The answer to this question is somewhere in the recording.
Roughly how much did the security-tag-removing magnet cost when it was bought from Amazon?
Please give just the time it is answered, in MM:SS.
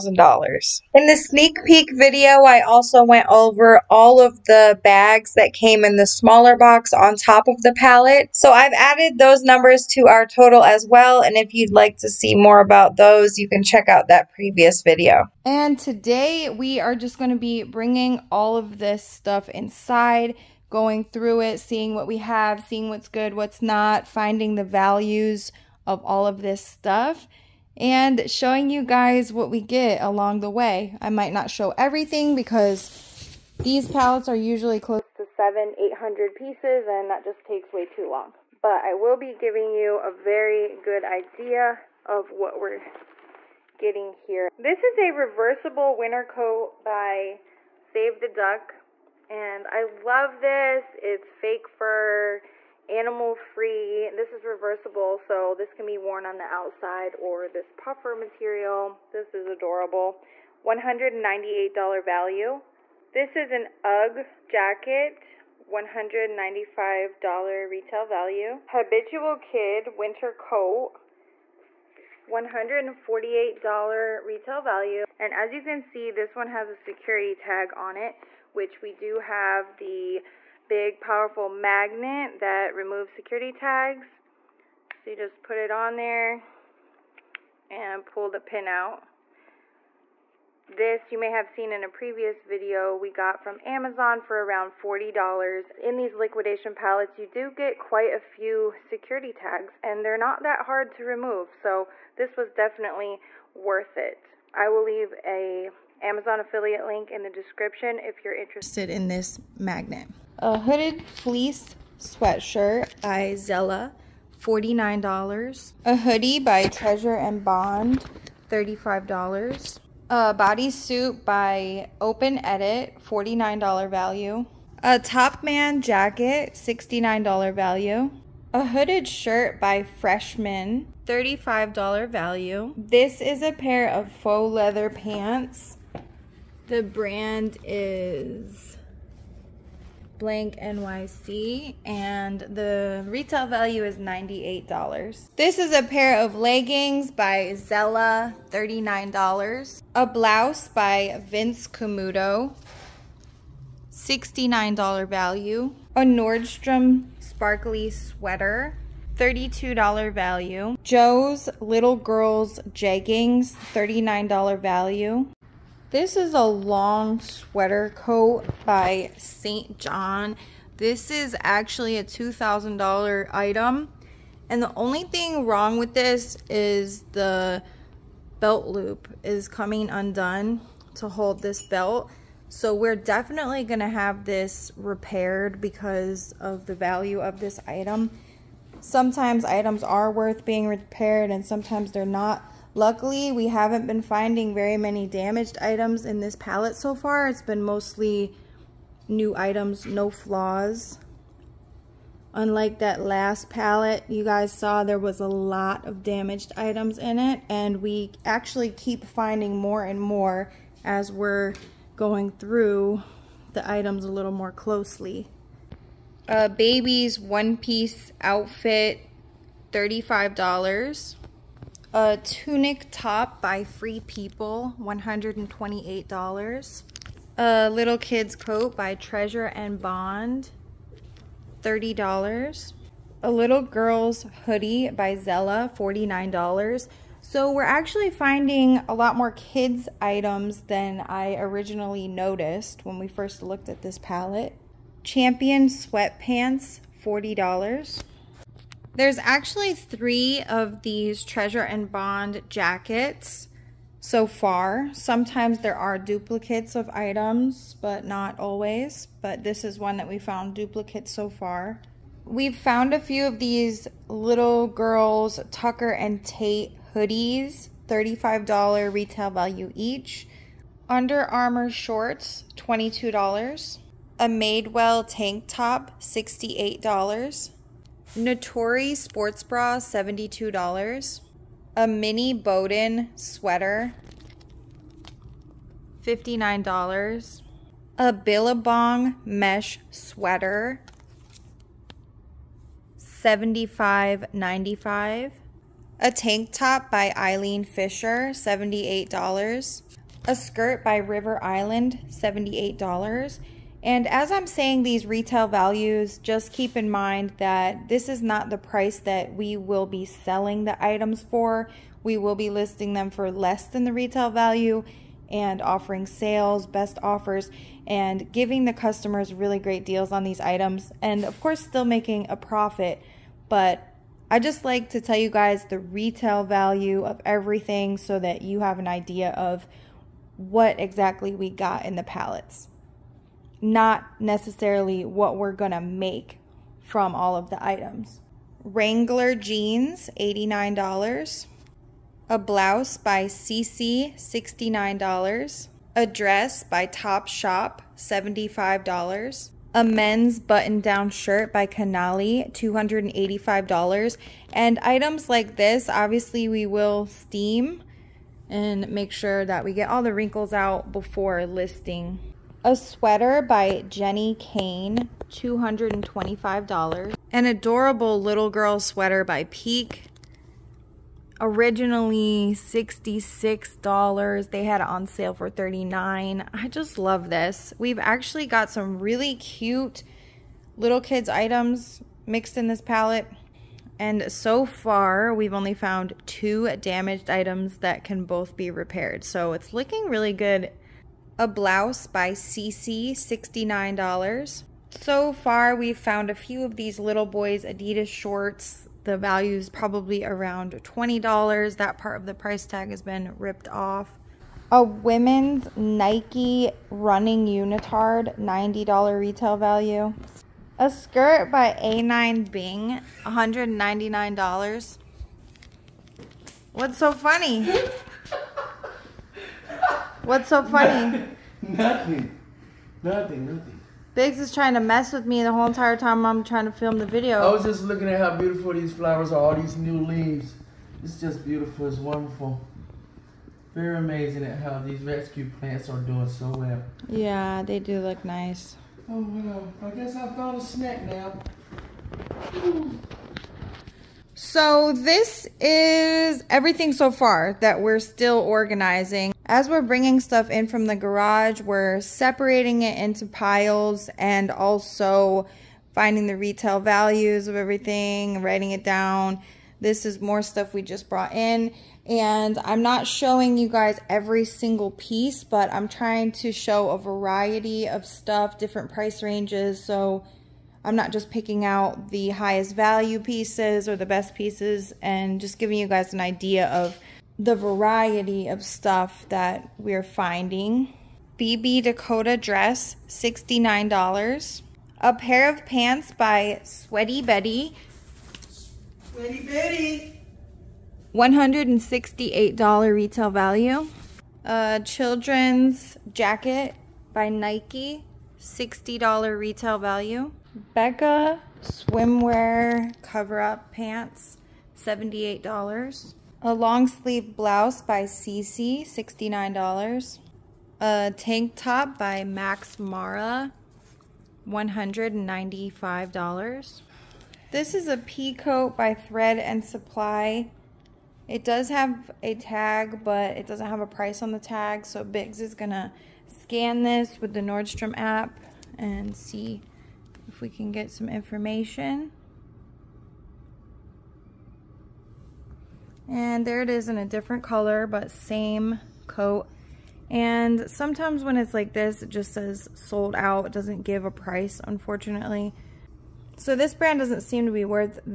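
01:34.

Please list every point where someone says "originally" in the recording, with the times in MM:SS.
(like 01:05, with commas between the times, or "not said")
04:01, 06:11.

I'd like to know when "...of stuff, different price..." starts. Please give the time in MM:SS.
07:47.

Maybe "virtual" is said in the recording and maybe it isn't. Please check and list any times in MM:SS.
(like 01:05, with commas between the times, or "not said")
not said.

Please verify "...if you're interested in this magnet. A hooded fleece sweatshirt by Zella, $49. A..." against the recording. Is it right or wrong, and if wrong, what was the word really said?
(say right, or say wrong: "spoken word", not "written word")
right.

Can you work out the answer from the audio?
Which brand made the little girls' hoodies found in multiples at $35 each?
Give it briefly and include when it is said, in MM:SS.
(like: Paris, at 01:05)
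Tucker and Tate, at 04:25.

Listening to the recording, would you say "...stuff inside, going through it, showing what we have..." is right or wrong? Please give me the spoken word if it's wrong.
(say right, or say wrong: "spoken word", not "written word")
wrong: "seeing", not "showing".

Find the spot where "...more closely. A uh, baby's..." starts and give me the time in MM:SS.
03:34.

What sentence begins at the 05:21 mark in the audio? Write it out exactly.
And of course, still making a profit.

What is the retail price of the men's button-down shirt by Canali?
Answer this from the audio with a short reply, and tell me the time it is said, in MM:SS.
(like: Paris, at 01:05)
$285, at 05:52.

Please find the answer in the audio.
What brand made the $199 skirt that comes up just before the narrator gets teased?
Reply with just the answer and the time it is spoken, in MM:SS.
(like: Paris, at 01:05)
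Anine Bing, at 06:51.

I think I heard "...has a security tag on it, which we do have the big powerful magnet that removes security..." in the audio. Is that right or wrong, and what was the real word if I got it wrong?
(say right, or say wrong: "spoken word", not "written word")
right.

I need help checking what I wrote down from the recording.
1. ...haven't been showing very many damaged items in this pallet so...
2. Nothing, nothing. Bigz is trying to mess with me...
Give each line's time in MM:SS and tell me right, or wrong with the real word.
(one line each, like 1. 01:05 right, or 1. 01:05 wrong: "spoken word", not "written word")
1. 03:13 wrong: "finding", not "showing"
2. 07:03 right.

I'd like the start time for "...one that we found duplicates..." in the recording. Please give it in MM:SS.
04:19.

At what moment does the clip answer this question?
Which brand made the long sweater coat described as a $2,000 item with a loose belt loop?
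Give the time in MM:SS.
02:49.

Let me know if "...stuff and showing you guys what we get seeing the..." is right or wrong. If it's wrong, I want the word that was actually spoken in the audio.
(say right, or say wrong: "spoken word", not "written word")
wrong: "along", not "seeing".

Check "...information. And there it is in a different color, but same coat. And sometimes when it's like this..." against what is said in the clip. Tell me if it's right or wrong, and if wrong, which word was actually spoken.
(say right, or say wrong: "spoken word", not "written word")
right.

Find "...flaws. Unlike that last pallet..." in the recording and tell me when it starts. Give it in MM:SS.
03:20.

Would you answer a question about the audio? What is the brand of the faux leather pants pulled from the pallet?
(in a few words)
blank NYC.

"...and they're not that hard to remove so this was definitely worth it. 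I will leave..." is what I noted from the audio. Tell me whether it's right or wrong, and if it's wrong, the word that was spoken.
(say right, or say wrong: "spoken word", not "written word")
right.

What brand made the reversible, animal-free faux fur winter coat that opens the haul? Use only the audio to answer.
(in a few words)
Save the Duck.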